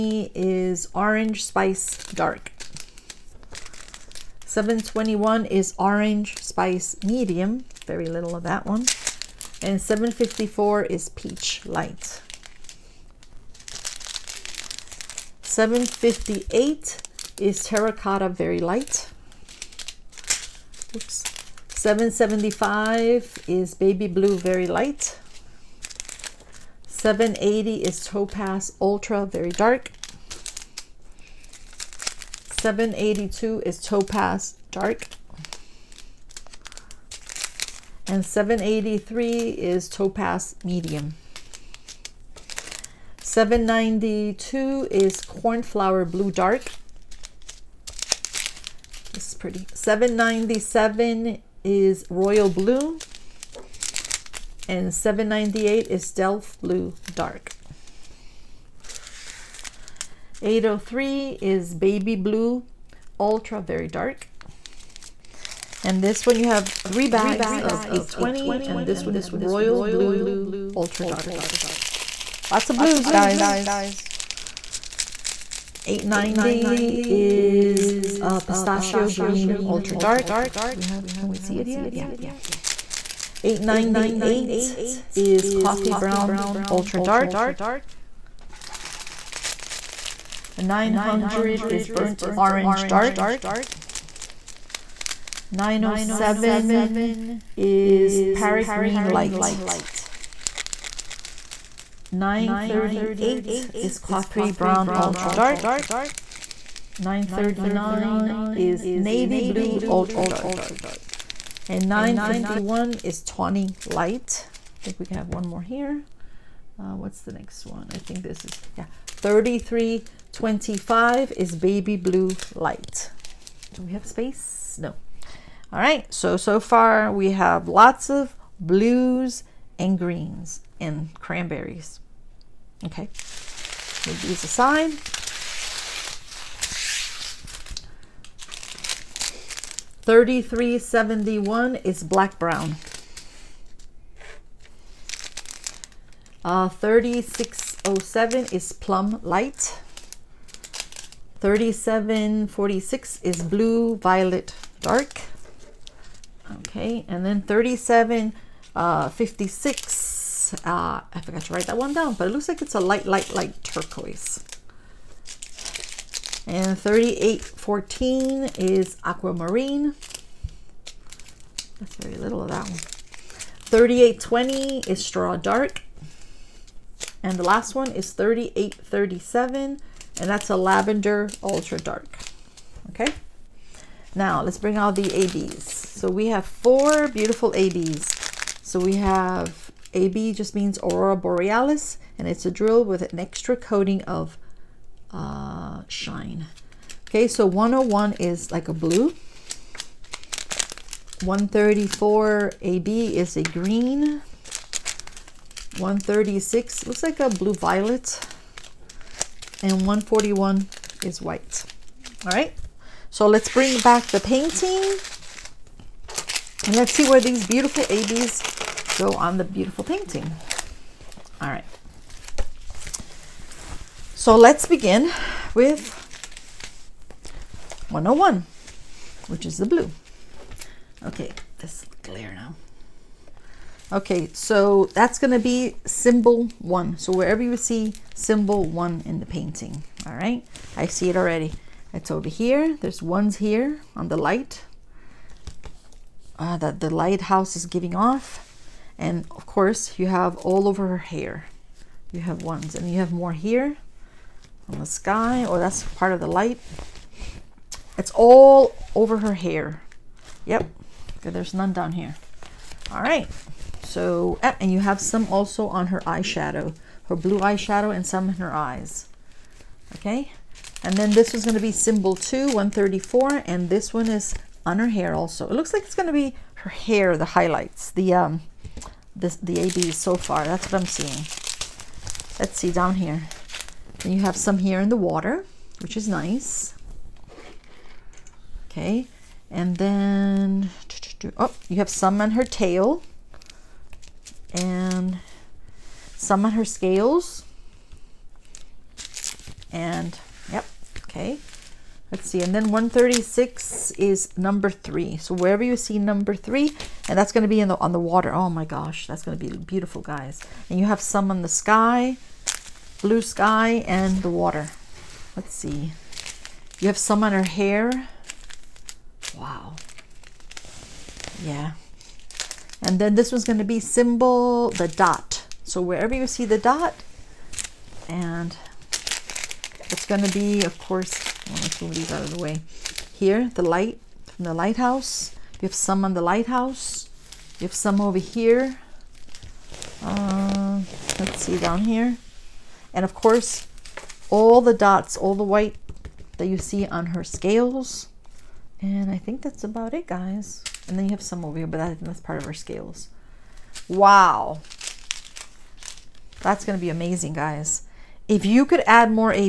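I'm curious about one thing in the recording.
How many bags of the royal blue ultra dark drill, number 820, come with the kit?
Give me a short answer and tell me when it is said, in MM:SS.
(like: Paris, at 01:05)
3, at 01:06.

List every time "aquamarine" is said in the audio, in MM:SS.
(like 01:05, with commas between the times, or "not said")
02:49.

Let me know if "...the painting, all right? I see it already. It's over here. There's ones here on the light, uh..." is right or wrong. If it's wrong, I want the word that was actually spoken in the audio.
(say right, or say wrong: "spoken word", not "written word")
right.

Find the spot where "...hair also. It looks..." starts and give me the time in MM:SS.
04:34.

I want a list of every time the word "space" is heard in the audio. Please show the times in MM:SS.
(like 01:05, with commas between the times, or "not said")
02:04.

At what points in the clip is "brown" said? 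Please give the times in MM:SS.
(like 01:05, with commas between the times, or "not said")
01:25, 01:44, 02:22.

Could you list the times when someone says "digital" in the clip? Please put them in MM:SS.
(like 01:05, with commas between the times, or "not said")
not said.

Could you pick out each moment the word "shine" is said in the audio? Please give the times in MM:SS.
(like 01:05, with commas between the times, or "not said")
03:15.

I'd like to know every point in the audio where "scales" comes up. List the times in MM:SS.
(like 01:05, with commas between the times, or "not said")
04:56, 05:47, 05:52.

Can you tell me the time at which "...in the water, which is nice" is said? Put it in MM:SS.
04:44.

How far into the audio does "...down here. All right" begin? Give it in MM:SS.
04:21.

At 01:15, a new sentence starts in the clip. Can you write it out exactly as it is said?
890 is a pistachio green ultra dark.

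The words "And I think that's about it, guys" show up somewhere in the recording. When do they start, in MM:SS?
05:48.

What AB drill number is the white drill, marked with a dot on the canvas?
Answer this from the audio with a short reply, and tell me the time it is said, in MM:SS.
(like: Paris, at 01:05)
141, at 03:29.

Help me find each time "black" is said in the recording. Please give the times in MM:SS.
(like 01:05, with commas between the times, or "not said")
02:22.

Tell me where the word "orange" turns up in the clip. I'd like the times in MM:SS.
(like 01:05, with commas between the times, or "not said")
00:00, 00:05, 01:32.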